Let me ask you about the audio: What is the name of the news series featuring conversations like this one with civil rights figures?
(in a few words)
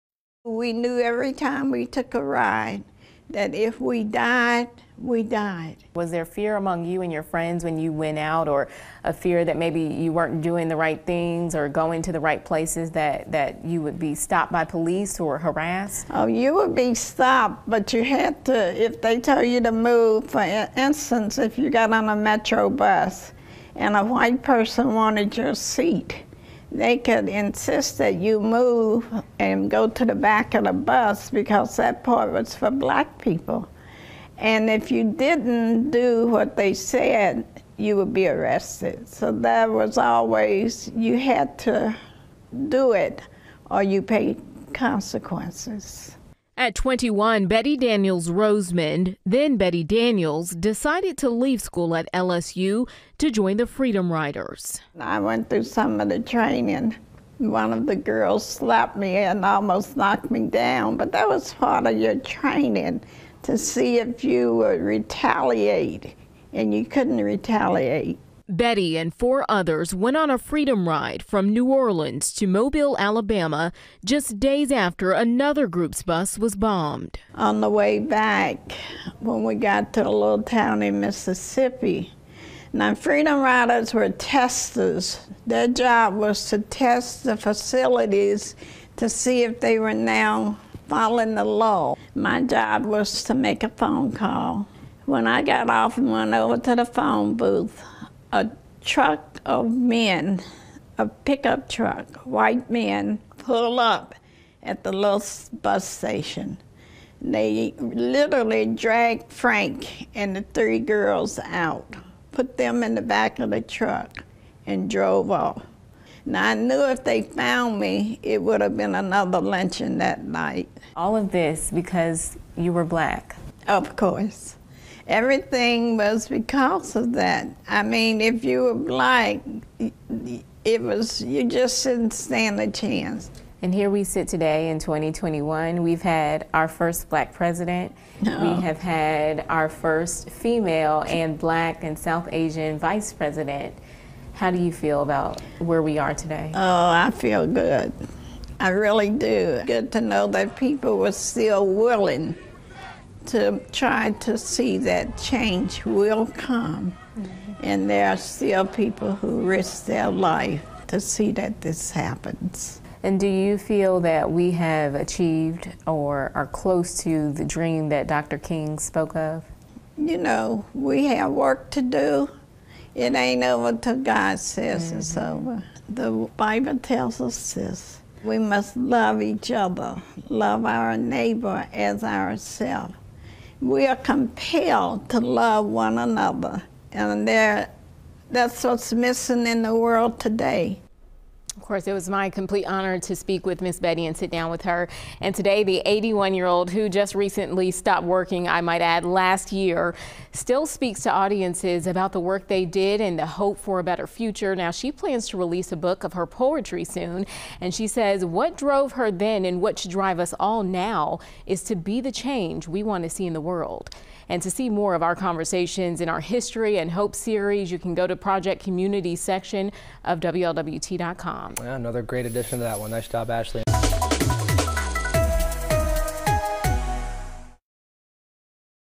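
History and Hope.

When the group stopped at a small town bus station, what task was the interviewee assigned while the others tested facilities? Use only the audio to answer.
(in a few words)
Make a phone call.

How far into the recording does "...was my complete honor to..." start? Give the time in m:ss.
3:11.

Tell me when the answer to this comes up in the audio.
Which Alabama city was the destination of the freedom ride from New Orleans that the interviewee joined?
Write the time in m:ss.
1:12.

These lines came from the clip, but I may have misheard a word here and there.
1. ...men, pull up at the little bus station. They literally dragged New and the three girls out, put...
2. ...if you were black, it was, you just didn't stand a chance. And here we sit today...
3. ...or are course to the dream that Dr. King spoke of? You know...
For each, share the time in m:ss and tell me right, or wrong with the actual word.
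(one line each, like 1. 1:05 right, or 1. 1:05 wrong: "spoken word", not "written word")
1. 1:42 wrong: "Frank", not "New"
2. 2:08 right
3. 2:45 wrong: "close", not "course".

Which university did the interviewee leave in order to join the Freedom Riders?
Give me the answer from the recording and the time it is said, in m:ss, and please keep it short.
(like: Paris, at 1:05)
LSU, at 0:52.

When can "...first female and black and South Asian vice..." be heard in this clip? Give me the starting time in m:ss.
2:19.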